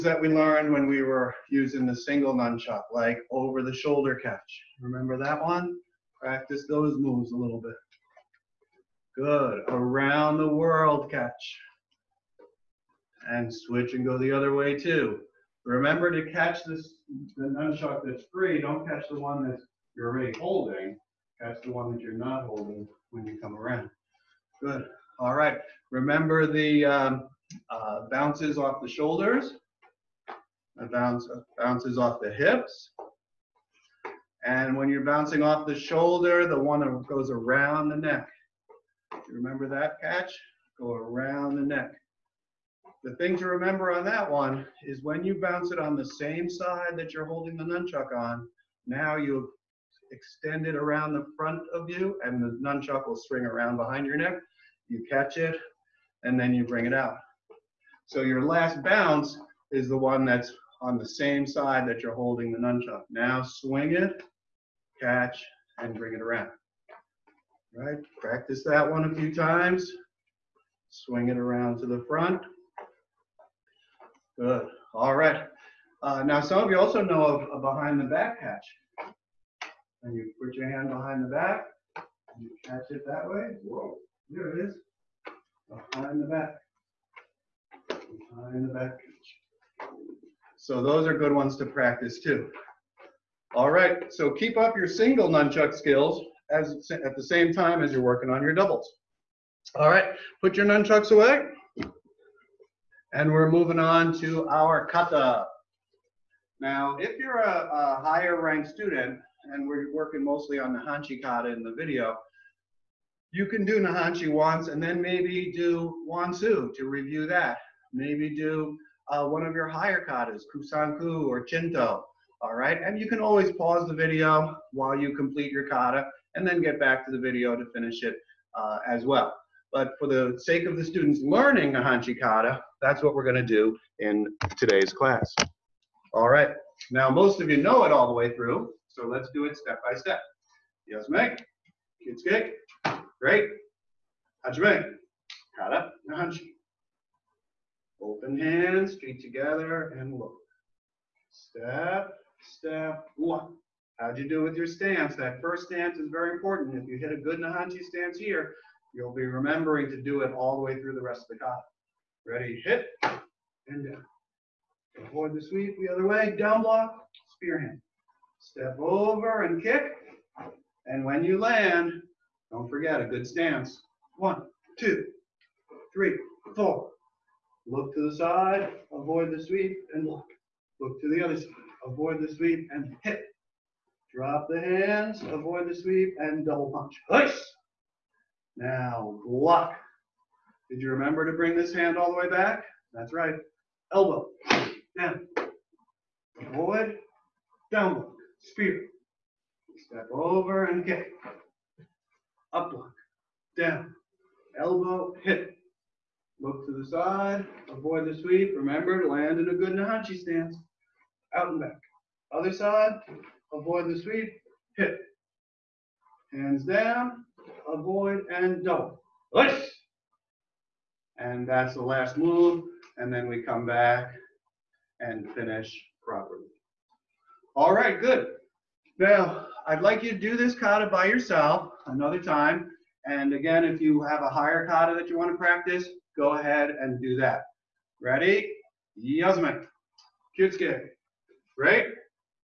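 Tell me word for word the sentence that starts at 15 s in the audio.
Remember to catch this the nunchuck that's free.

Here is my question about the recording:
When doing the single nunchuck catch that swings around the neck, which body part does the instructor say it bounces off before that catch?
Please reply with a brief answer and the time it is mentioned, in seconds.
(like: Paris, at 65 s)
Shoulders, at 28 s.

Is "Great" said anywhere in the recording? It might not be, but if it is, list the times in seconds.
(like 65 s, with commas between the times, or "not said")
143 s.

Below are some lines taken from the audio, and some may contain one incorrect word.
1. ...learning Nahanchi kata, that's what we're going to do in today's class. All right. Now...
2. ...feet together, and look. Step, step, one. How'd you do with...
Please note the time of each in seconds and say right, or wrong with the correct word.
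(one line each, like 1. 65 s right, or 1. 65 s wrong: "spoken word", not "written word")
1. 131 s right
2. 148 s right.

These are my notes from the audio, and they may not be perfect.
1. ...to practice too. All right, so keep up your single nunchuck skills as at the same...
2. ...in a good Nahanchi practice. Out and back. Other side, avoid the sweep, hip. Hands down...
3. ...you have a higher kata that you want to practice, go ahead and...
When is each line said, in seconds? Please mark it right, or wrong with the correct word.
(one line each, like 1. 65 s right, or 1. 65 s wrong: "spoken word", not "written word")
1. 91 s right
2. 209 s wrong: "stance", not "practice"
3. 233 s right.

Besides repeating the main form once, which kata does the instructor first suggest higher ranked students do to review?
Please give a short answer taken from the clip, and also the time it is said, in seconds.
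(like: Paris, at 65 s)
Wansu, at 116 s.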